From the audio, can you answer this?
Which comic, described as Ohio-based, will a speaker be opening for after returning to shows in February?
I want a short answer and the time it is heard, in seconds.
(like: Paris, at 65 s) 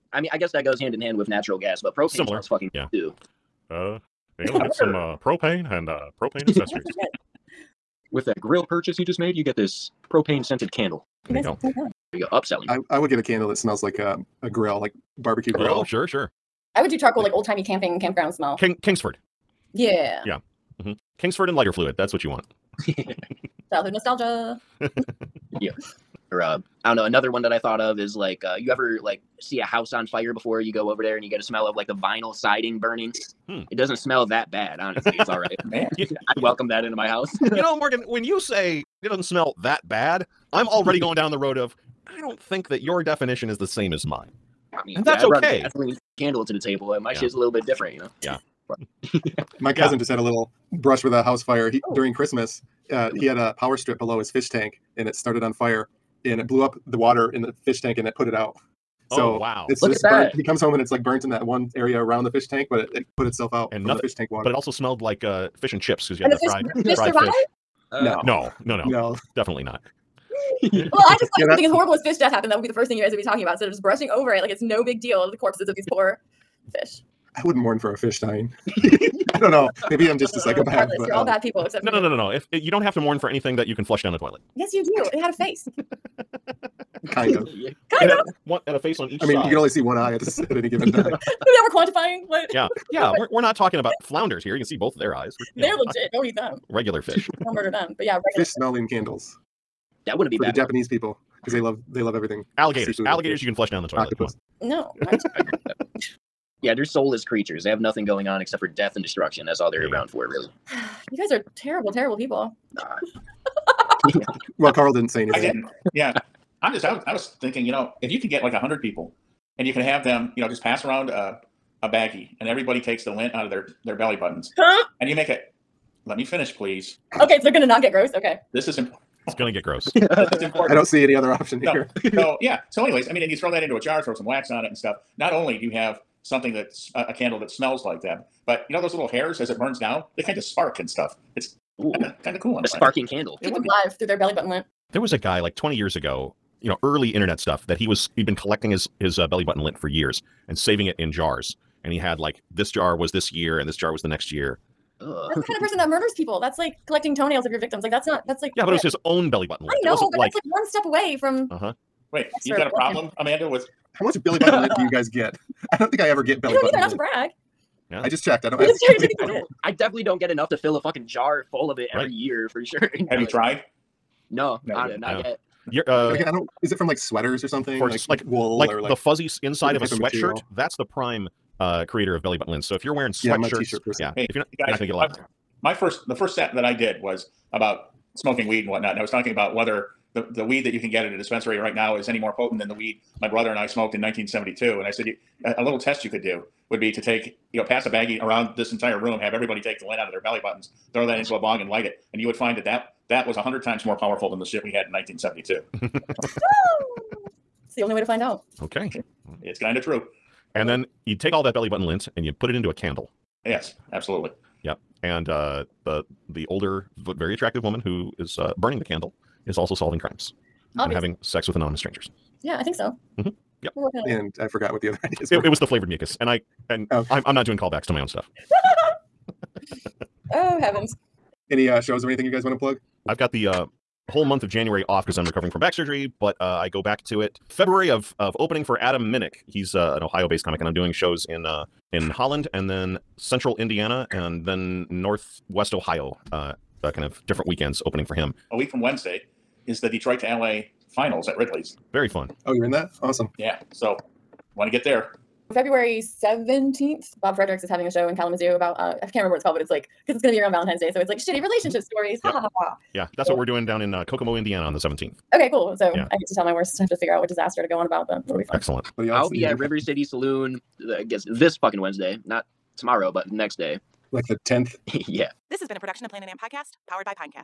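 Adam Minnick, at 238 s.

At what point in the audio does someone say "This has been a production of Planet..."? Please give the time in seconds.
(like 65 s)
275 s.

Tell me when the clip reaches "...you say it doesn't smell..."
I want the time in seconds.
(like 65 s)
38 s.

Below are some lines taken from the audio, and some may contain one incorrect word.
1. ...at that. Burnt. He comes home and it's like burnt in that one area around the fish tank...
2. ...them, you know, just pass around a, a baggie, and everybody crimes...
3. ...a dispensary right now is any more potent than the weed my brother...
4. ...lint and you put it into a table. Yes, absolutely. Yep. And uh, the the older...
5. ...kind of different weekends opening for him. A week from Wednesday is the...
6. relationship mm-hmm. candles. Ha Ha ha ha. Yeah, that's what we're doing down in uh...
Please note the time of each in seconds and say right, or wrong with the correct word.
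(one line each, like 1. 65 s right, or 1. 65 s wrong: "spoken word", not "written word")
1. 59 s right
2. 120 s wrong: "takes", not "crimes"
3. 191 s right
4. 211 s wrong: "candle", not "table"
5. 246 s right
6. 261 s wrong: "stories", not "candles".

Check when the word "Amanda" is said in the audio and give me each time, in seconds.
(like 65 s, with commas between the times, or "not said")
163 s.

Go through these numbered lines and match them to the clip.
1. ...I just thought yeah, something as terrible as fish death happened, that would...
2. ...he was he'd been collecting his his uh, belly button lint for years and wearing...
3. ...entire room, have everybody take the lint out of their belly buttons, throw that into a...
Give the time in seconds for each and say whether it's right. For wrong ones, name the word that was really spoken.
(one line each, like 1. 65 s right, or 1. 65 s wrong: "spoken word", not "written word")
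1. 70 s wrong: "horrible", not "terrible"
2. 147 s wrong: "saving", not "wearing"
3. 198 s right.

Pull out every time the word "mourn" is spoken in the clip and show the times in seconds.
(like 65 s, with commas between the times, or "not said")
77 s, 82 s.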